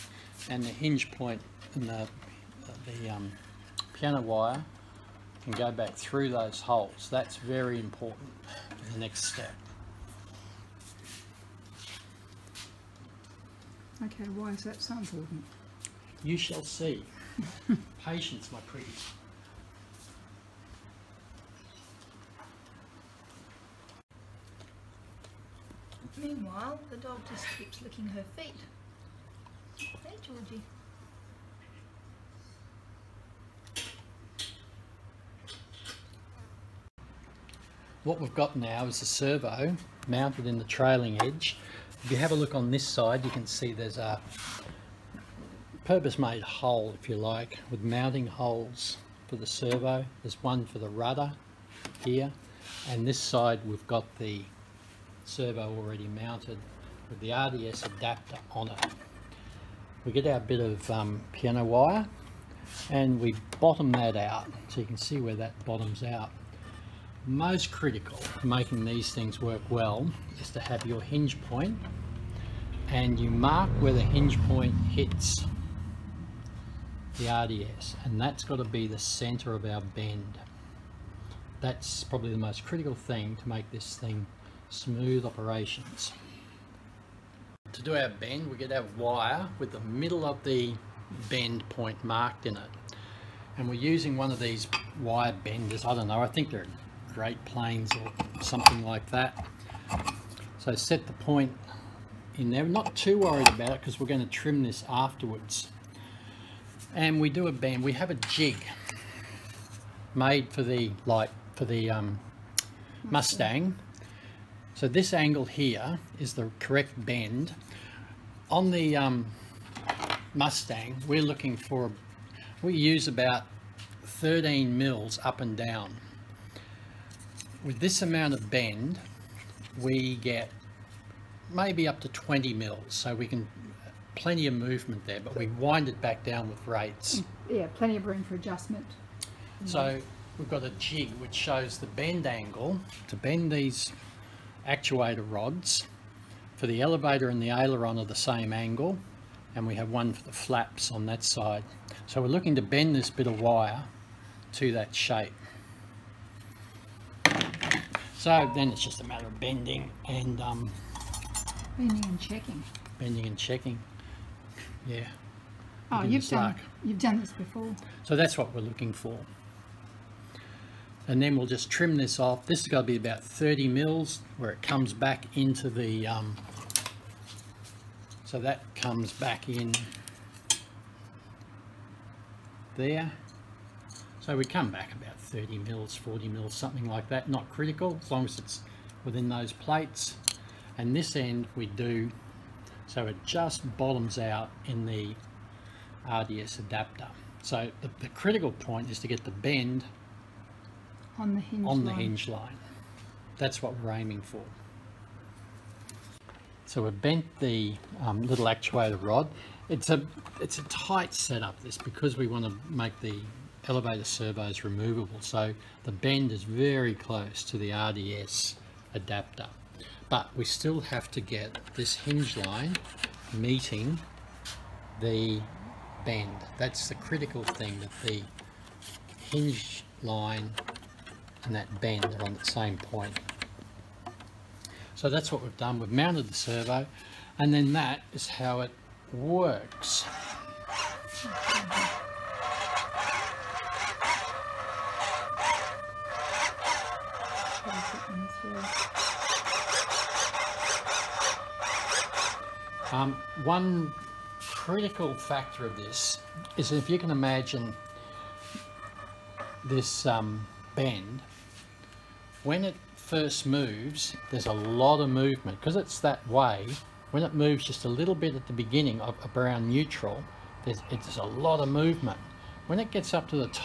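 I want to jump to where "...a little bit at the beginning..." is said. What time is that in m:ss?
4:27.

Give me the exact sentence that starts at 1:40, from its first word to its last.
So set the point in there.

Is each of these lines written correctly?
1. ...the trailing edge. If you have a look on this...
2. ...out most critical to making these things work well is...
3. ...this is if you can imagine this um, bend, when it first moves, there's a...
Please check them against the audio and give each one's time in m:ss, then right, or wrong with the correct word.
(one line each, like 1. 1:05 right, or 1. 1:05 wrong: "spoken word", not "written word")
1. 0:40 right
2. 1:06 right
3. 4:15 right.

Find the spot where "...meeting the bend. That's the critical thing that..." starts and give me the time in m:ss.
3:43.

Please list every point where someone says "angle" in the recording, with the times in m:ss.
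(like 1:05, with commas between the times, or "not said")
1:55, 2:22, 2:28.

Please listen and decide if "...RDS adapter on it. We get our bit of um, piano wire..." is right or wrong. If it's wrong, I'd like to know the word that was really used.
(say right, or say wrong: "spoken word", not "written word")
right.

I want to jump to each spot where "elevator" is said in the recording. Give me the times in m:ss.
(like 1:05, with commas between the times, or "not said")
2:26, 3:33.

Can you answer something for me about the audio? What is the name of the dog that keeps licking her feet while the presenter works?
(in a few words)
Georgie.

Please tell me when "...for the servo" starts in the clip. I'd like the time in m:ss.
0:49.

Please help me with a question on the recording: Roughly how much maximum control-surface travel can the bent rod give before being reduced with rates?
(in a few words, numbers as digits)
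20 mm.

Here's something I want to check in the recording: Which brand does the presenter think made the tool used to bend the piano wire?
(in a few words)
Great Planes.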